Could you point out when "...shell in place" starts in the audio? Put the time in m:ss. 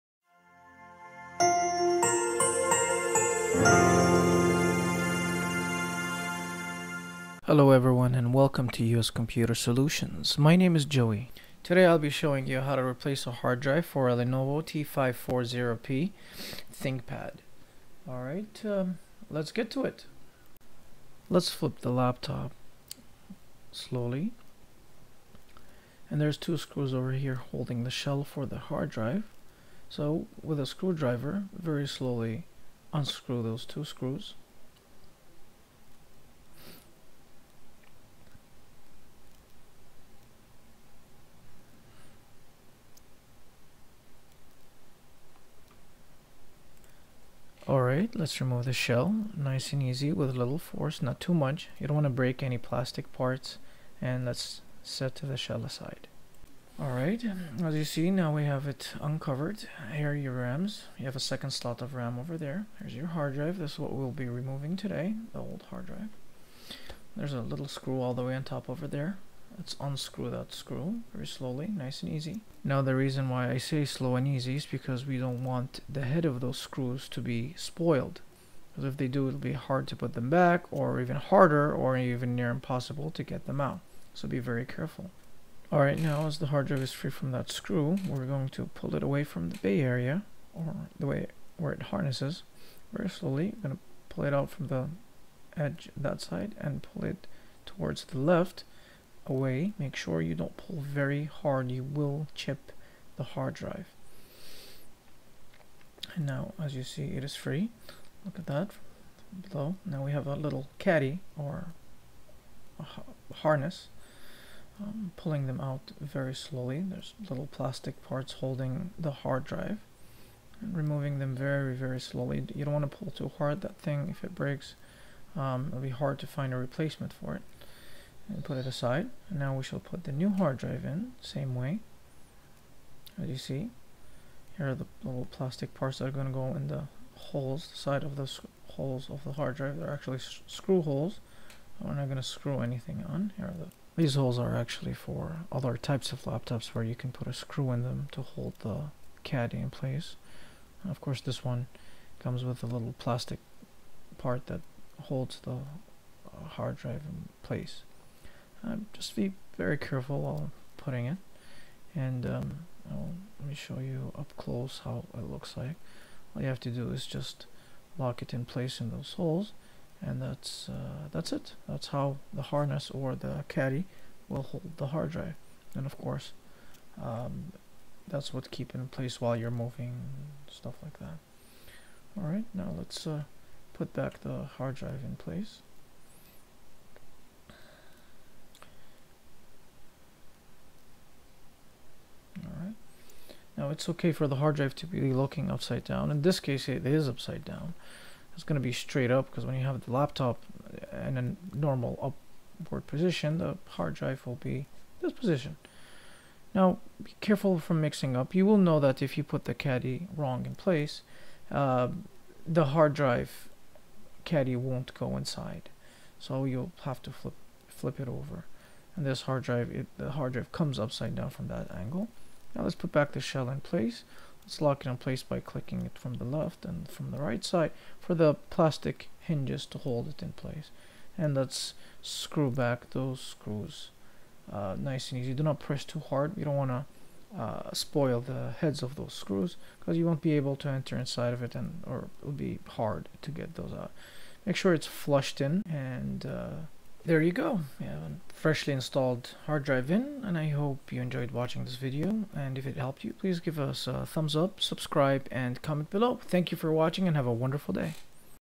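3:43.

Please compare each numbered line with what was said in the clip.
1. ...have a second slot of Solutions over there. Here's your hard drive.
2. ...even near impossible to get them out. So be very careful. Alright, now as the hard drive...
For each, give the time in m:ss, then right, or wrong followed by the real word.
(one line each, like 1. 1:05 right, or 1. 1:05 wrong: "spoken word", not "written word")
1. 1:01 wrong: "RAM", not "Solutions"
2. 1:21 right.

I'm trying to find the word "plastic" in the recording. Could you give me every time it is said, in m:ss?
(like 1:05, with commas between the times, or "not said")
0:52, 1:57, 2:15, 2:32, 3:48.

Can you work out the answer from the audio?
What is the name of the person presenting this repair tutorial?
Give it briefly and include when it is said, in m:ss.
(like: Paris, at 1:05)
Joey, at 0:10.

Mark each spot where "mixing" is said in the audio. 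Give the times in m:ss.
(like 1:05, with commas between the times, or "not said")
3:27.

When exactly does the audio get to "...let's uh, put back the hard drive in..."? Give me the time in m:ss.
3:02.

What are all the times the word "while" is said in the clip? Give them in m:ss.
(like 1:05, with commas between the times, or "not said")
2:40, 2:59.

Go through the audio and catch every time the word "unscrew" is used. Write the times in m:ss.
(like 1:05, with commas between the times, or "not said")
0:32, 1:09.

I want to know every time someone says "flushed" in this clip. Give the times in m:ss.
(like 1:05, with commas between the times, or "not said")
4:04.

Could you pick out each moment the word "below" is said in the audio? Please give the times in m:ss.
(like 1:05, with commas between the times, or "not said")
1:49, 4:15.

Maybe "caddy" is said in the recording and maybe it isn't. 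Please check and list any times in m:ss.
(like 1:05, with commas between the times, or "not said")
1:50, 2:29, 2:53, 3:29, 3:34.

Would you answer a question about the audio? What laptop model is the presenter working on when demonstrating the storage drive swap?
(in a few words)
Lenovo T540p ThinkPad.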